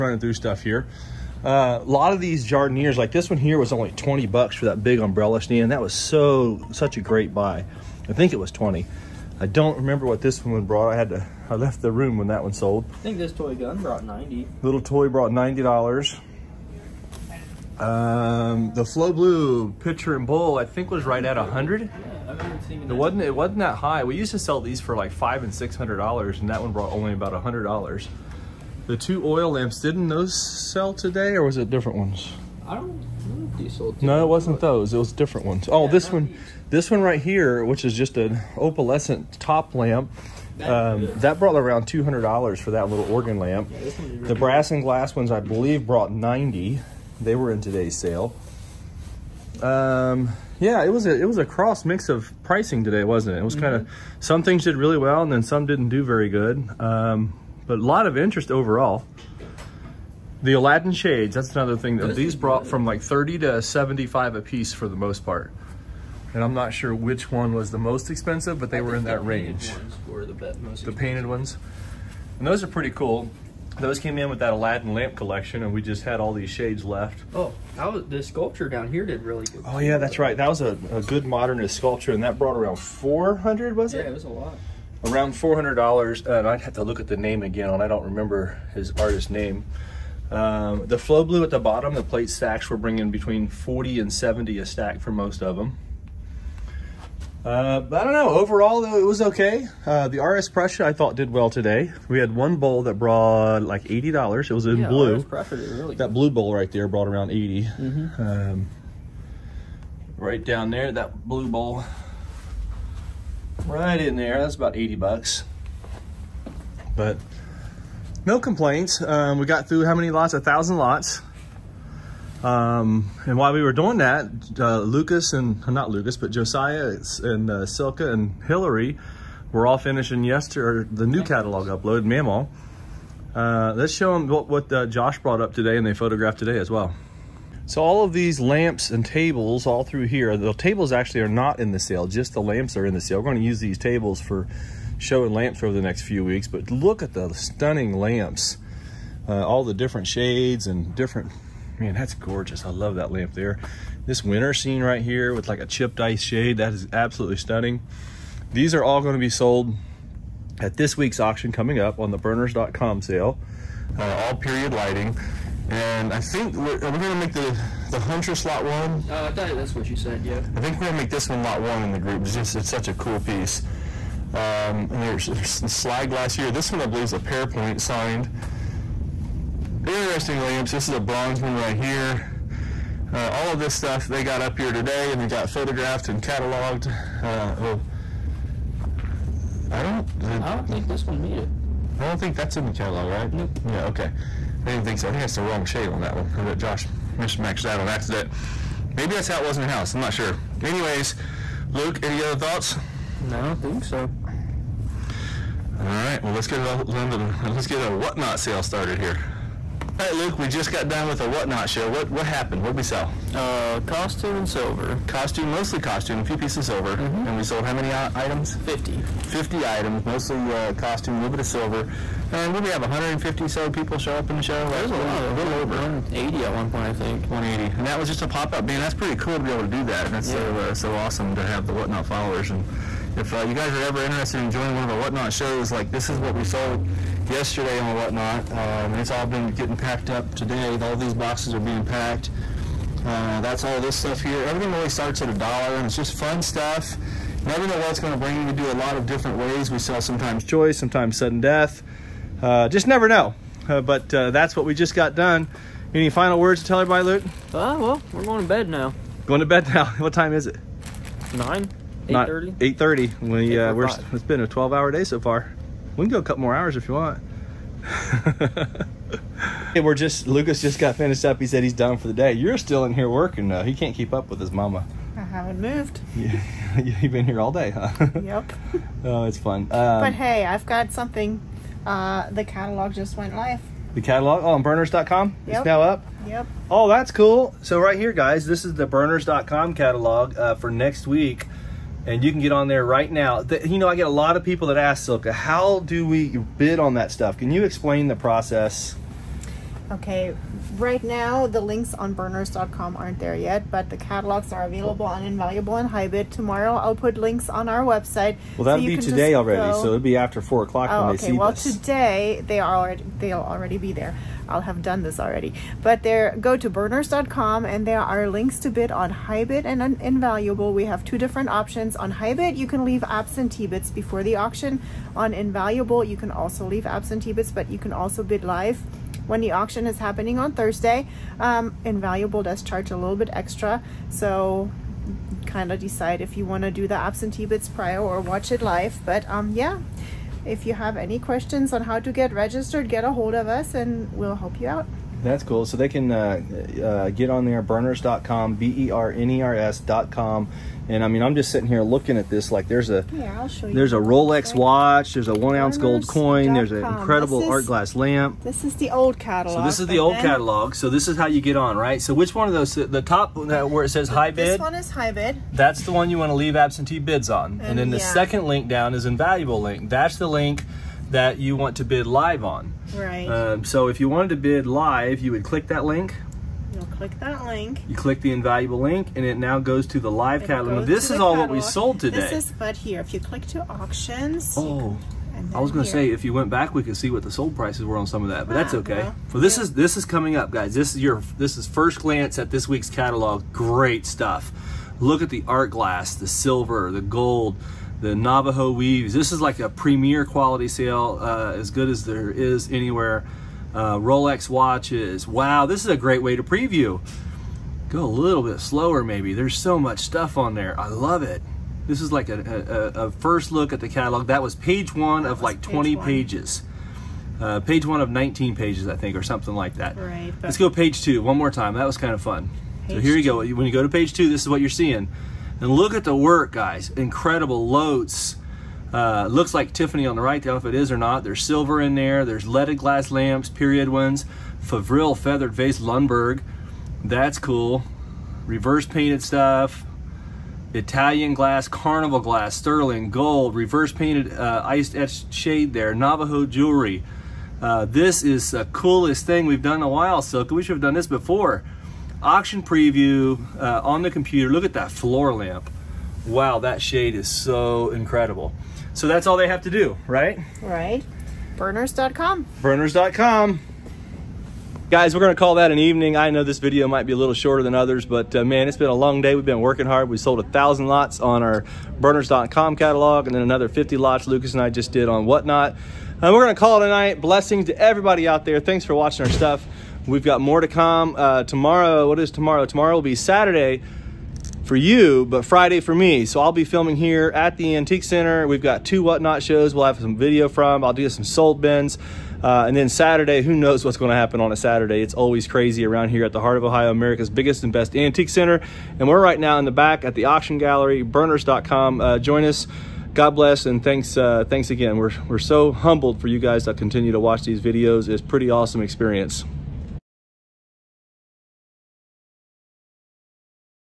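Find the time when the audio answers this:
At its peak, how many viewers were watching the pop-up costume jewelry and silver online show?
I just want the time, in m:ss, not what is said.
3:45.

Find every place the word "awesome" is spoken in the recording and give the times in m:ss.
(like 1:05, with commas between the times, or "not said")
3:50, 8:28.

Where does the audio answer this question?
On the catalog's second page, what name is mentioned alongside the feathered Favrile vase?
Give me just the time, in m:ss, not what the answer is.
7:15.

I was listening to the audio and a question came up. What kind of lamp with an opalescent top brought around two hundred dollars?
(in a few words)
organ lamp.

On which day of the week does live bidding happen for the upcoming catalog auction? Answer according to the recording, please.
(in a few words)
Thursday.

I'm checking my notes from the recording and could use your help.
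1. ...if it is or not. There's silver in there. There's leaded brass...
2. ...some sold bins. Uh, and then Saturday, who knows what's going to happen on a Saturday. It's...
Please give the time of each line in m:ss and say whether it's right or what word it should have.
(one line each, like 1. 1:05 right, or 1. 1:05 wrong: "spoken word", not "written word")
1. 7:10 wrong: "glass", not "brass"
2. 8:11 right.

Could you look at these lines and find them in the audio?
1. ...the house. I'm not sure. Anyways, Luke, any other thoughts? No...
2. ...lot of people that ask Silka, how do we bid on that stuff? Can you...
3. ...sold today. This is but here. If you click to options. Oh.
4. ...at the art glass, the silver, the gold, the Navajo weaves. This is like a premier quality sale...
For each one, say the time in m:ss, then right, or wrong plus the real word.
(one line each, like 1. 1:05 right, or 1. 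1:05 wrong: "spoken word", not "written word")
1. 3:19 right
2. 4:54 right
3. 6:21 wrong: "auctions", not "options"
4. 6:35 right.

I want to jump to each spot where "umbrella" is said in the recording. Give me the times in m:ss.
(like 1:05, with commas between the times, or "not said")
0:04.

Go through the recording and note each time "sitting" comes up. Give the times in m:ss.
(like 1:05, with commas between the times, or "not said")
5:51.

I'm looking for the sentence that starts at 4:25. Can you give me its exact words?
We can go a couple more hours if you want.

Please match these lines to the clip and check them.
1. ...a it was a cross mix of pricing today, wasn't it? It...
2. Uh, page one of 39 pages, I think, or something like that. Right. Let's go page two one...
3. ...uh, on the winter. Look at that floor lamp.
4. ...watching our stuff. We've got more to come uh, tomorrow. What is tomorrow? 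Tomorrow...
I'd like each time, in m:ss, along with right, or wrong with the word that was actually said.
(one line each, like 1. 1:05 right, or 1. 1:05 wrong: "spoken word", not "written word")
1. 0:51 right
2. 6:57 wrong: "19", not "39"
3. 7:33 wrong: "computer", not "winter"
4. 7:58 right.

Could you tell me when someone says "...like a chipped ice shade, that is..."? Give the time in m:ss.
2:35.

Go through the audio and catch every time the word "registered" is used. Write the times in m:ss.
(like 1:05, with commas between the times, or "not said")
5:42.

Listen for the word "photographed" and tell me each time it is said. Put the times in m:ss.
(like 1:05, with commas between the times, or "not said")
2:15, 3:05.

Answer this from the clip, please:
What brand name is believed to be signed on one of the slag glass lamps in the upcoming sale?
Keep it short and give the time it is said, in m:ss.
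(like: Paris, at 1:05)
Pairpoint, at 2:57.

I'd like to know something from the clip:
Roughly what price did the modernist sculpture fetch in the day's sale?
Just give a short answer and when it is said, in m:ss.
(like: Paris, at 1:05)
$400, at 1:25.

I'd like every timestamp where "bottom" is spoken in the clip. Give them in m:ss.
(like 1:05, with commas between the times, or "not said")
1:31.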